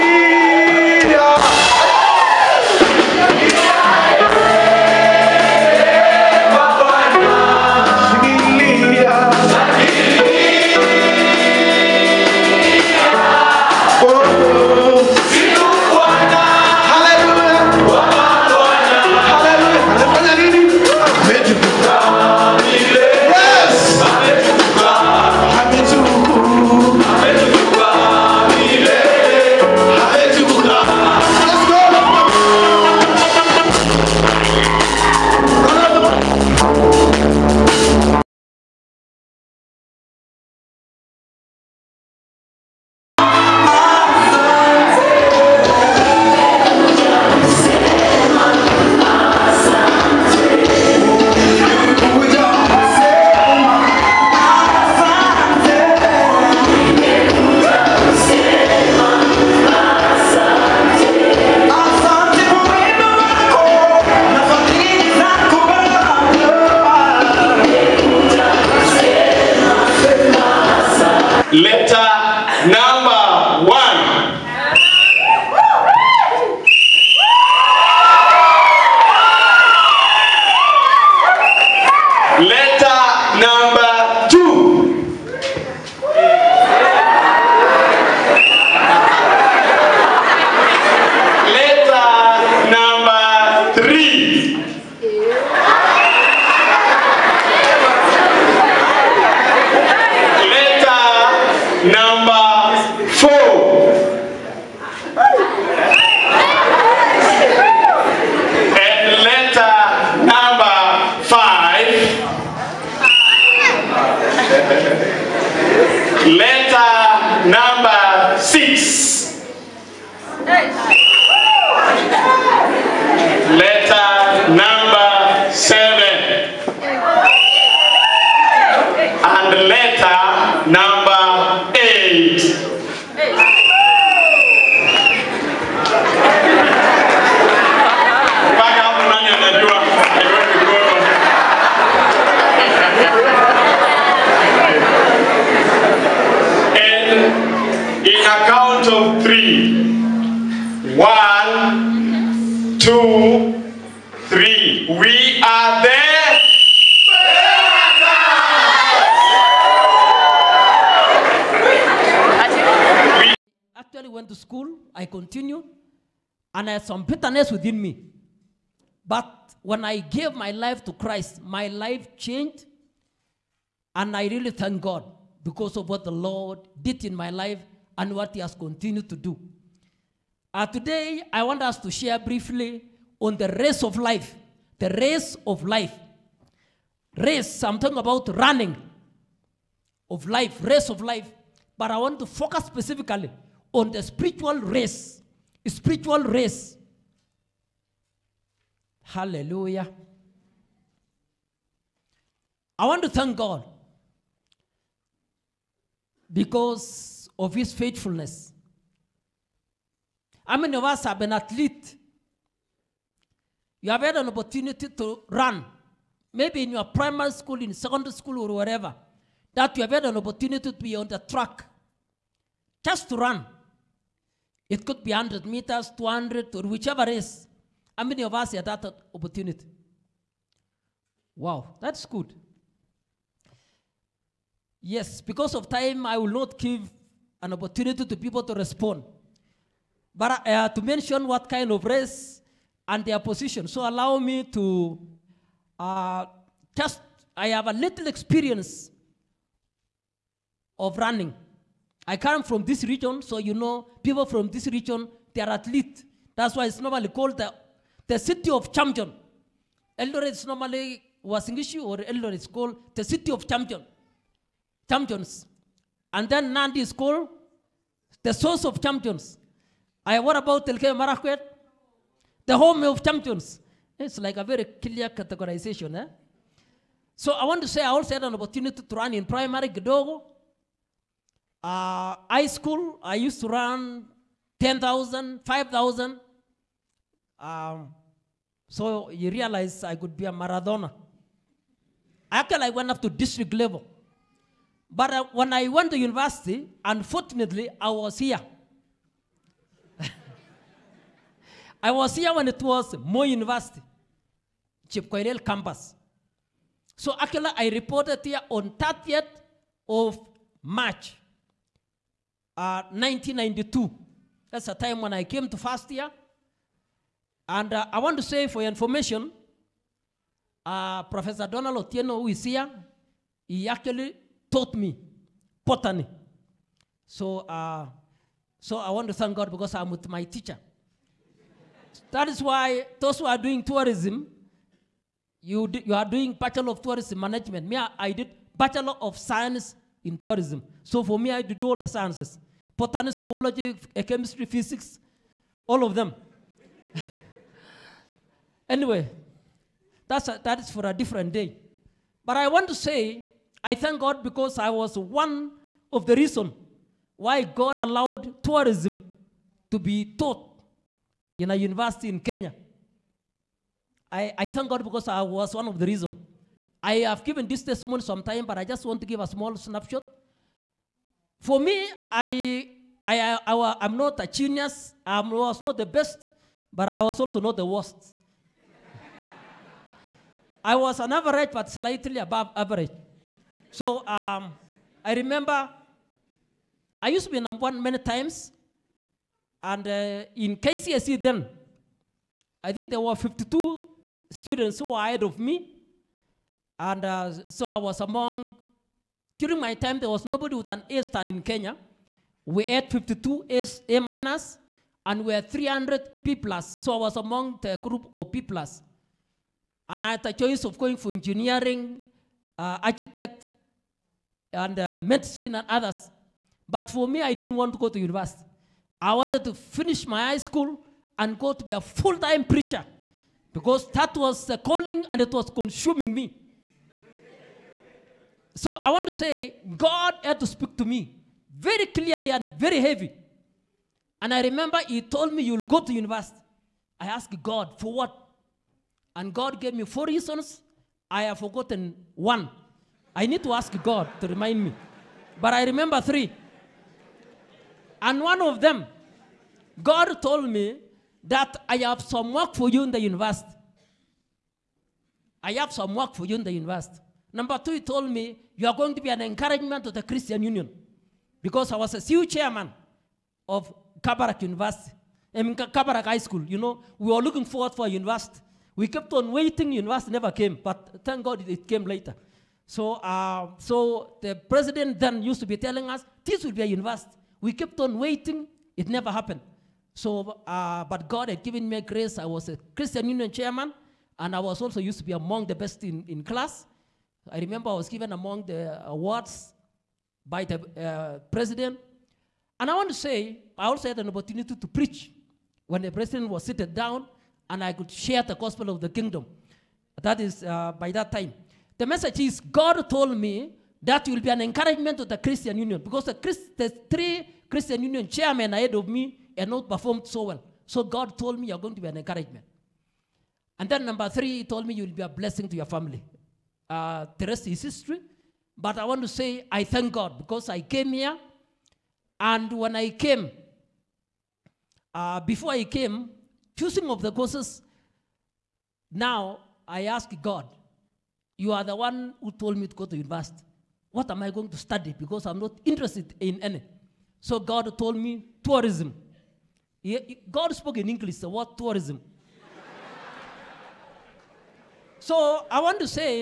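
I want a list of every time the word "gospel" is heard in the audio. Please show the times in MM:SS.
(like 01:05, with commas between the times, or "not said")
08:18.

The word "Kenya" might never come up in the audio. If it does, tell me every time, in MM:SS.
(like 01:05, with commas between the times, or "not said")
06:02, 06:41.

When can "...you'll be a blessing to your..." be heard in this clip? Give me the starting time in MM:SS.
08:34.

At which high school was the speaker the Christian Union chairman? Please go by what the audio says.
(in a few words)
Kabarak High School.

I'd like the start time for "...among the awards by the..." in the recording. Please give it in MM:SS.
08:08.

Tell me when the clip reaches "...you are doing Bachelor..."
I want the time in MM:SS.
05:35.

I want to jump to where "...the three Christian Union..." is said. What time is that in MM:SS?
08:26.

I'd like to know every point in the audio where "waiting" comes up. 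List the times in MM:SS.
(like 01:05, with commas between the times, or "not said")
07:49, 07:57.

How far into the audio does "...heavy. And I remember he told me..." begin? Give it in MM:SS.
07:12.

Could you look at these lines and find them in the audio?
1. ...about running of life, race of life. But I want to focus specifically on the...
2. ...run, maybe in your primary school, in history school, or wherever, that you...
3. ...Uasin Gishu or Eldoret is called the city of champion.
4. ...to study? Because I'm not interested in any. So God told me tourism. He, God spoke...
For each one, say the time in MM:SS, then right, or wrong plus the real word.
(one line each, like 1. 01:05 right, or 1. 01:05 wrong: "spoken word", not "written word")
1. 03:07 right
2. 03:35 wrong: "secondary", not "history"
3. 04:21 right
4. 08:54 right.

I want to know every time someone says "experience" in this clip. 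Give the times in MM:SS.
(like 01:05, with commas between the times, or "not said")
04:08.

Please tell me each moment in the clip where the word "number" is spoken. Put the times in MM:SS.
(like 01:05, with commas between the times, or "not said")
06:27, 07:37, 08:33.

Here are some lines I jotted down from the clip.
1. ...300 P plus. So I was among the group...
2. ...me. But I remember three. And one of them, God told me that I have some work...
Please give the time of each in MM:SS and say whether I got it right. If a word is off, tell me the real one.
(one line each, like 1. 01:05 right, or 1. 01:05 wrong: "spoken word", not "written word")
1. 06:45 right
2. 07:24 right.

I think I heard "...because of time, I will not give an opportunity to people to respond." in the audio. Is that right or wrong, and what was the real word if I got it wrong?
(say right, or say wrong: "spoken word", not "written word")
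right.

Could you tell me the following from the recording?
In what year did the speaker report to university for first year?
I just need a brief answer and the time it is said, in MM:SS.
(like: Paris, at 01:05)
1992, at 05:12.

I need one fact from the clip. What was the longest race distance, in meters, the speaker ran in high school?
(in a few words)
10,000.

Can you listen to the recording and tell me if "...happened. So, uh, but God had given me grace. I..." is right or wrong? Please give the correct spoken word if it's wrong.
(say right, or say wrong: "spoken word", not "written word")
right.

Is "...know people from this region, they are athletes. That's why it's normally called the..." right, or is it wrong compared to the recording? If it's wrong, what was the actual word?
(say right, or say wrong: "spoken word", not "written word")
right.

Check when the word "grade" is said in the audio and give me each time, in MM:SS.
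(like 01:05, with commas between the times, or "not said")
not said.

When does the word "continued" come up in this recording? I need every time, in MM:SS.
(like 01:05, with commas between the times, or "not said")
02:58.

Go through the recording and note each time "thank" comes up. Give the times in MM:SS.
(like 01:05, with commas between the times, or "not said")
02:54, 03:23, 05:29, 05:53, 06:04, 07:51, 08:39.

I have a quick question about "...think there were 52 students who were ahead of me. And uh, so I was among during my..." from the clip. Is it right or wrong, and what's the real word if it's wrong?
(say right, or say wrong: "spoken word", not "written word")
right.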